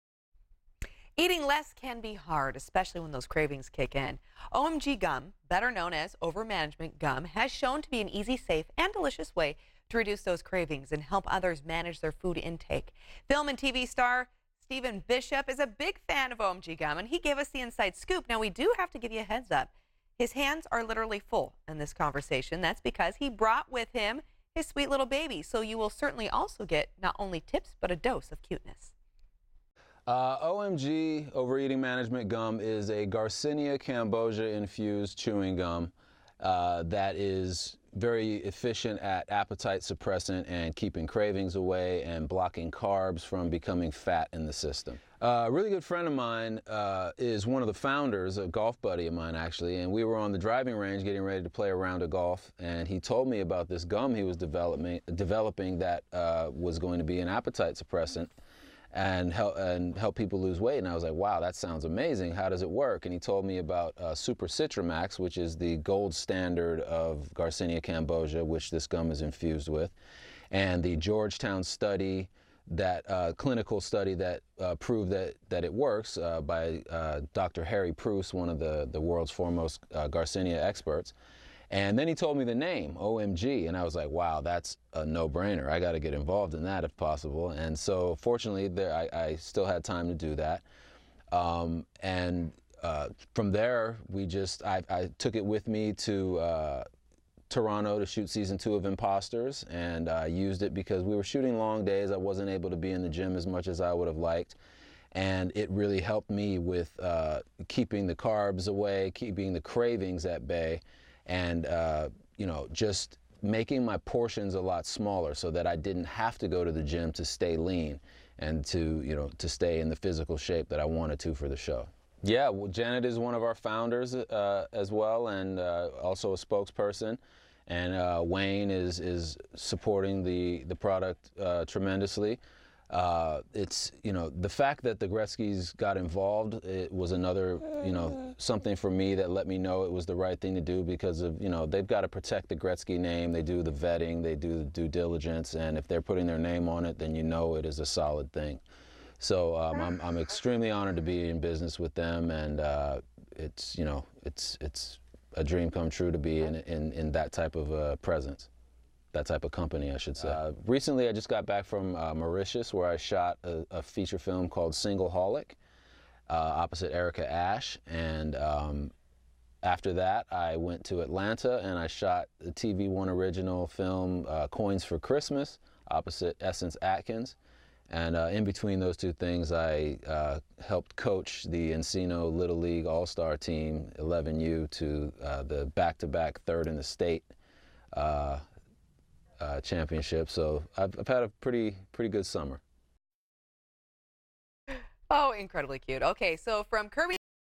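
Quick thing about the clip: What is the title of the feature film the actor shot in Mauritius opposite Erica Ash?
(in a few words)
Single Holic.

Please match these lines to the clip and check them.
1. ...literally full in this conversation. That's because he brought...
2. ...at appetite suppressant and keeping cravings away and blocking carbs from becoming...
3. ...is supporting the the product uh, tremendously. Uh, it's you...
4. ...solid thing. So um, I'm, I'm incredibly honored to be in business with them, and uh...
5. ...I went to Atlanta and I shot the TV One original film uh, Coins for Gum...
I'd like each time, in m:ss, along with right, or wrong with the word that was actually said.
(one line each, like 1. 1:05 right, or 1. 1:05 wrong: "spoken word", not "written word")
1. 0:20 right
2. 0:38 right
3. 2:08 right
4. 2:27 wrong: "extremely", not "incredibly"
5. 2:50 wrong: "Christmas", not "Gum".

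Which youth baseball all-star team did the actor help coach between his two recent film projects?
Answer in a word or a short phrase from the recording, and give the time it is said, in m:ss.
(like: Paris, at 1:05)
Encino Little League, at 3:01.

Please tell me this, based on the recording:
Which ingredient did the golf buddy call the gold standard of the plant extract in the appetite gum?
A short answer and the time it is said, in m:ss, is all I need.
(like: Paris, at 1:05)
Super CitriMax, at 1:04.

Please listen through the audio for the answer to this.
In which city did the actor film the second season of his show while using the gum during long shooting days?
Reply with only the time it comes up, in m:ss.
1:37.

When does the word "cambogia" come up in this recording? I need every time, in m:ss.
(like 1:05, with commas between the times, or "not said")
0:33, 1:07.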